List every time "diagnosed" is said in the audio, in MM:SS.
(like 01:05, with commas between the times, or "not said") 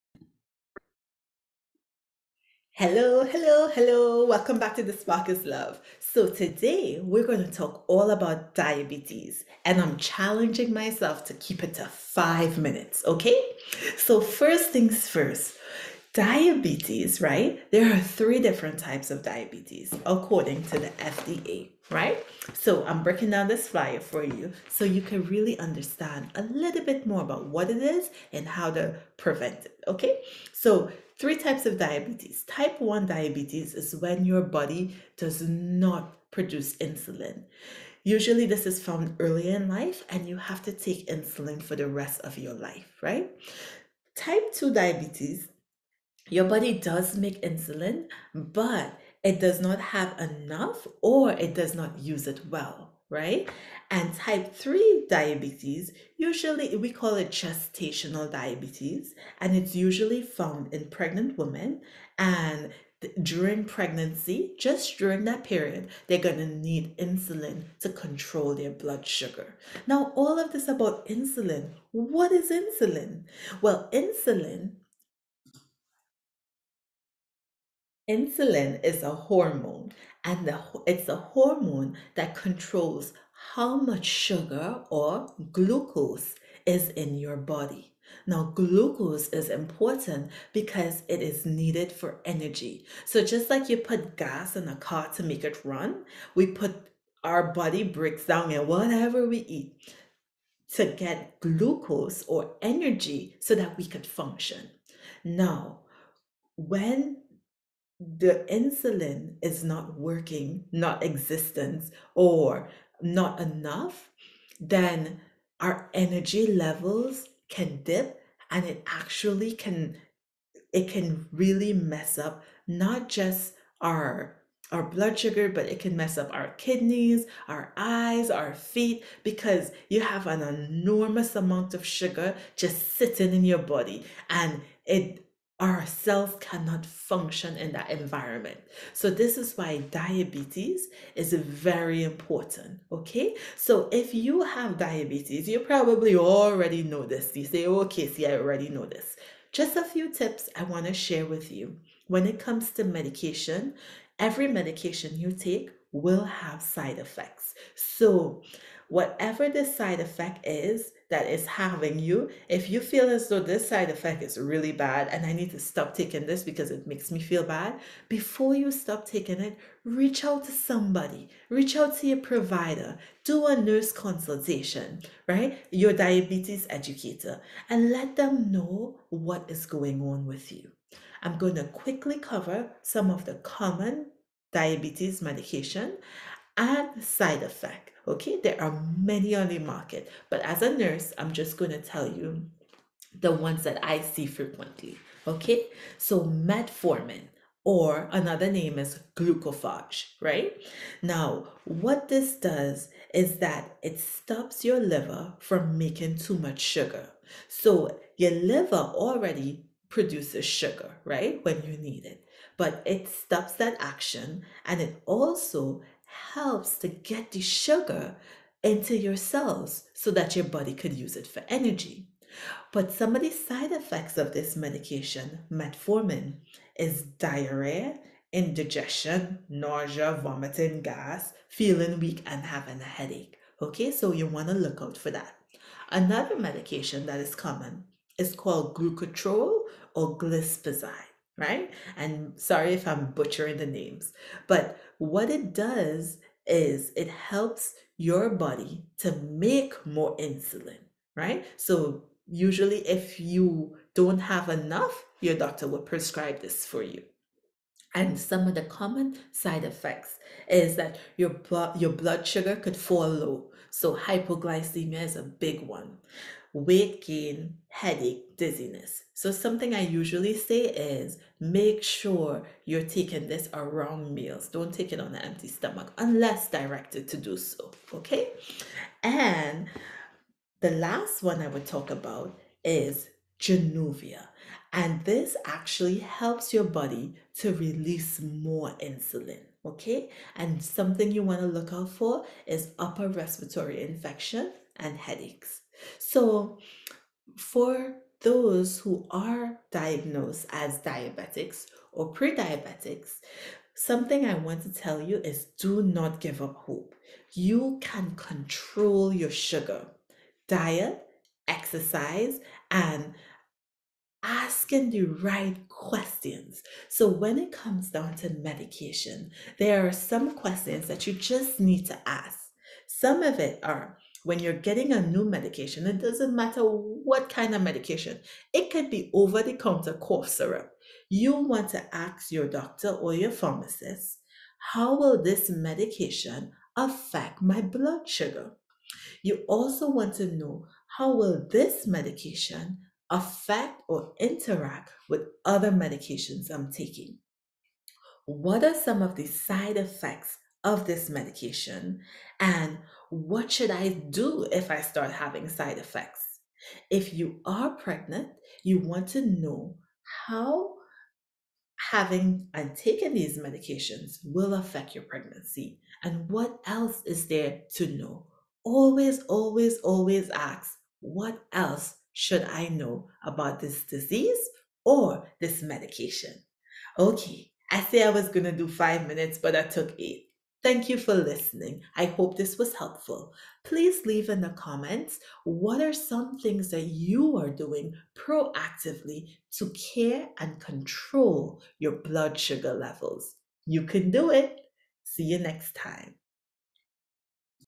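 04:59.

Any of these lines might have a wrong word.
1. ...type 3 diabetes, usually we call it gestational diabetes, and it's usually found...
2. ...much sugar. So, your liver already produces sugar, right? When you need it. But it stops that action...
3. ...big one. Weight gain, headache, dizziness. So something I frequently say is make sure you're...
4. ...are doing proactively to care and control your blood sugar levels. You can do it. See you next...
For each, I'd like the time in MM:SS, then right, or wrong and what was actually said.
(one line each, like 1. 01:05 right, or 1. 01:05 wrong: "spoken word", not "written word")
1. 00:54 right
2. 03:26 right
3. 04:25 wrong: "usually", not "frequently"
4. 06:27 right.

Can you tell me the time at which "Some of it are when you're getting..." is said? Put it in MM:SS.
05:22.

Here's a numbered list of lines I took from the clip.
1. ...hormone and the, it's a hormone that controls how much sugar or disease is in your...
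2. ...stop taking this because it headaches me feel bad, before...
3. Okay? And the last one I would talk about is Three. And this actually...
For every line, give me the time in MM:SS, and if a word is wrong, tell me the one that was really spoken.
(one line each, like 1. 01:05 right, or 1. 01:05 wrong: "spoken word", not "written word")
1. 01:19 wrong: "glucose", not "disease"
2. 02:45 wrong: "makes", not "headaches"
3. 04:37 wrong: "Januvia", not "Three".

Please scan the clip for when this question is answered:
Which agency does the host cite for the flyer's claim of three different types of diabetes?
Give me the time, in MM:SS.
00:21.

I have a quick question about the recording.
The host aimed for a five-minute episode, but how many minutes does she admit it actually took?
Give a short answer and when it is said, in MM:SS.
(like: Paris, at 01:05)
8, at 06:19.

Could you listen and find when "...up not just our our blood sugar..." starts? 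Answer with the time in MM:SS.
02:02.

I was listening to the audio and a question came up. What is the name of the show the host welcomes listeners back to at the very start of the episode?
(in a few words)
The Spark is Love.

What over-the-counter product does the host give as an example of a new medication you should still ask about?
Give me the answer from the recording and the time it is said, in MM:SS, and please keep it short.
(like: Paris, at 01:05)
Cough syrup, at 05:29.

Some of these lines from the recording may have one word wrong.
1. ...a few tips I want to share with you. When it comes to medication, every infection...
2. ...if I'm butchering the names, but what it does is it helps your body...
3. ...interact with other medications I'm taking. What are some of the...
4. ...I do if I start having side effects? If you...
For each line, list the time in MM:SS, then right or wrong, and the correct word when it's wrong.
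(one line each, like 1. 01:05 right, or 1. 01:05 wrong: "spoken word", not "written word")
1. 02:29 wrong: "medication", not "infection"
2. 04:02 right
3. 05:44 right
4. 05:53 right.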